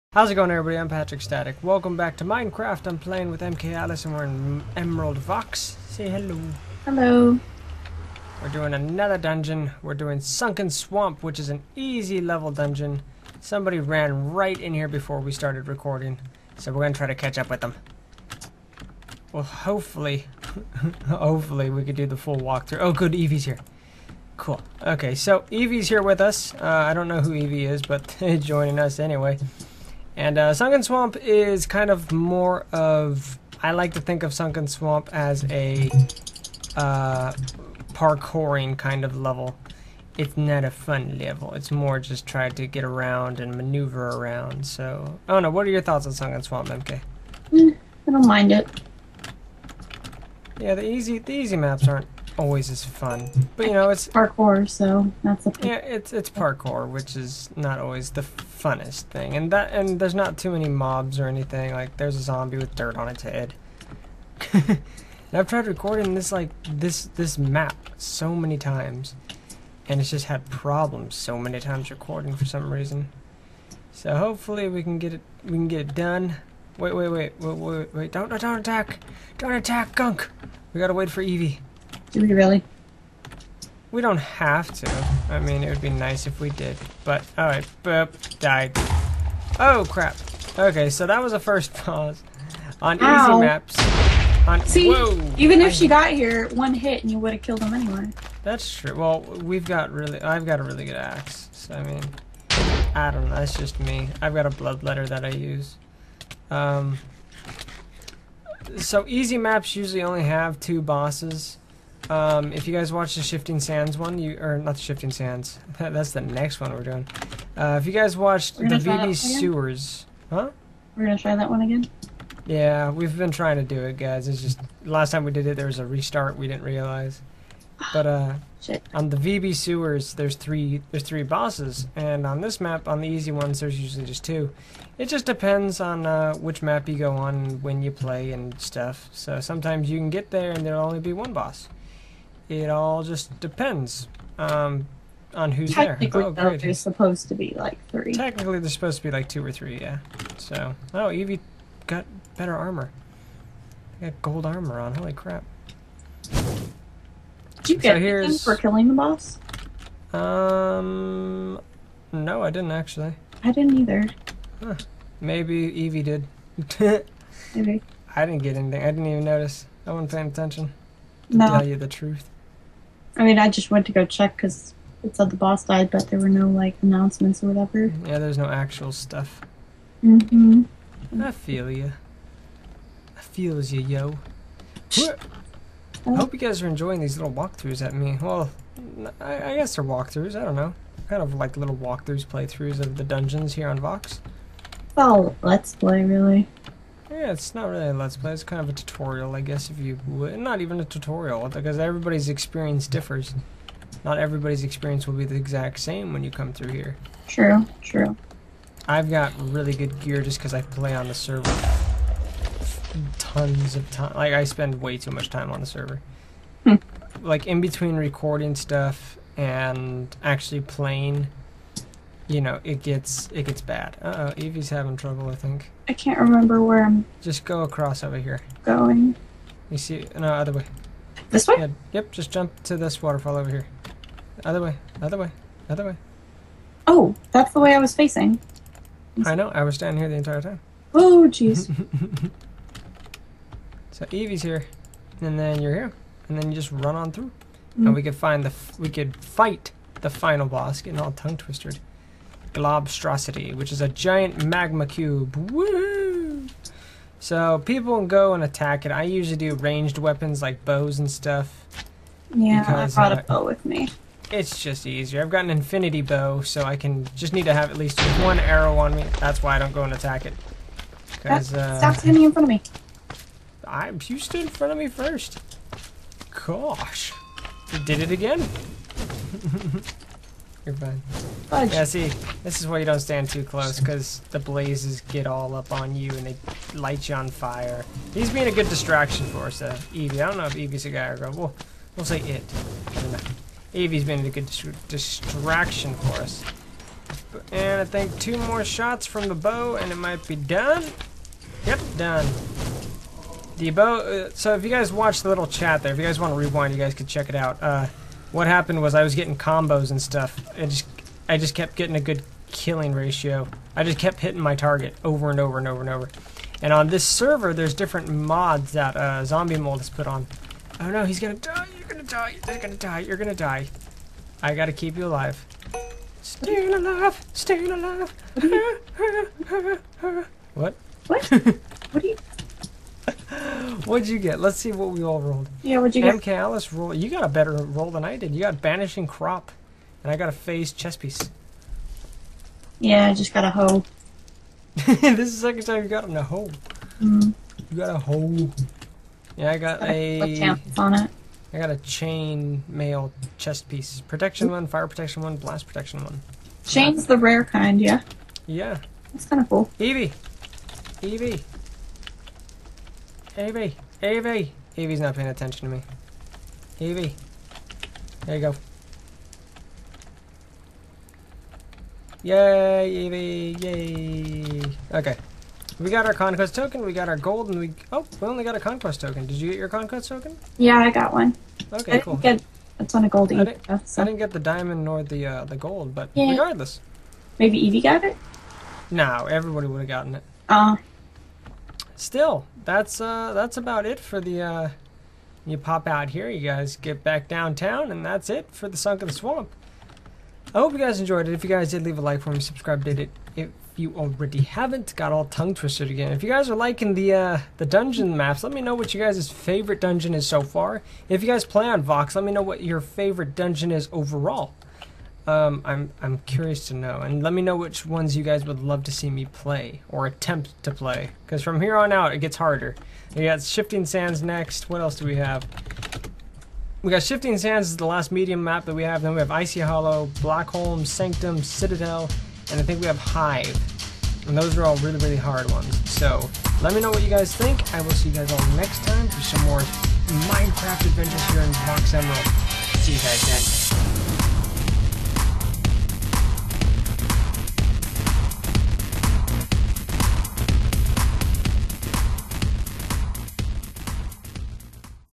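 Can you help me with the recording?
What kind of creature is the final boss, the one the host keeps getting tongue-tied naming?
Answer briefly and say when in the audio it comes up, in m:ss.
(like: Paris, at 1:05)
Giant magma cube, at 4:13.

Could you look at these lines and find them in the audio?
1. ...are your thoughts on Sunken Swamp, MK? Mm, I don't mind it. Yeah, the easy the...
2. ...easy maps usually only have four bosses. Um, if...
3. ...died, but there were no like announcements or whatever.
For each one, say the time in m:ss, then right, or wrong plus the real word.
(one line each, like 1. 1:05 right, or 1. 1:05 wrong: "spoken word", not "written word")
1. 0:45 right
2. 1:49 wrong: "two", not "four"
3. 2:55 right.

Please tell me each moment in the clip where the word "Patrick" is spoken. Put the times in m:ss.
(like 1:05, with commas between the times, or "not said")
0:00.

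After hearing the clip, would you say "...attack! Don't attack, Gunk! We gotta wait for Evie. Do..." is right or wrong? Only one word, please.
right.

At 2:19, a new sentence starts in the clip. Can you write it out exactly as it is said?
So sometimes you can get there, and there'll only be one boss.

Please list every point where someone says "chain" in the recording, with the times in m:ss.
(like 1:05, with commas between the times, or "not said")
5:51, 5:56.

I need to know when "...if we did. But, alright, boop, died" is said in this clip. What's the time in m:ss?
1:26.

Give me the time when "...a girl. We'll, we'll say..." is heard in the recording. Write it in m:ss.
4:51.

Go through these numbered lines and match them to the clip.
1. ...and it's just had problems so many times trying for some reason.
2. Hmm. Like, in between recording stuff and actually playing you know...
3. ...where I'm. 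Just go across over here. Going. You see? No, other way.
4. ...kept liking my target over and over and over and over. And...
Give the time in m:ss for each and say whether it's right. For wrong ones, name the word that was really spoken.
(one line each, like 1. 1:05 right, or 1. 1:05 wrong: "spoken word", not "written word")
1. 1:09 wrong: "recording", not "trying"
2. 3:36 right
3. 3:46 right
4. 5:13 wrong: "hitting", not "liking".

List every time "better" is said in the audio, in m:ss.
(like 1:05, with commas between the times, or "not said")
2:32, 5:37.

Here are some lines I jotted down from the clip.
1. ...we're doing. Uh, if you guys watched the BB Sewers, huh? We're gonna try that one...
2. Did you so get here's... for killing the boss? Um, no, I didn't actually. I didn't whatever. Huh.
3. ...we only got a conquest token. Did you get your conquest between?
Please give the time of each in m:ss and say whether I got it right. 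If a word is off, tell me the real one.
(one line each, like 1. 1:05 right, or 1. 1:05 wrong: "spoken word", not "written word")
1. 1:56 right
2. 2:36 wrong: "either", not "whatever"
3. 6:18 wrong: "token", not "between".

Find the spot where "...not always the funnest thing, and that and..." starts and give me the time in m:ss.
0:57.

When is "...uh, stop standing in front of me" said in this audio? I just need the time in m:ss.
4:31.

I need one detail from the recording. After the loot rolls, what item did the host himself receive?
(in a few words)
Phase Chess Piece.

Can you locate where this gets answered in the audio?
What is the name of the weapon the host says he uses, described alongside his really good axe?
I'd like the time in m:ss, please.
1:44.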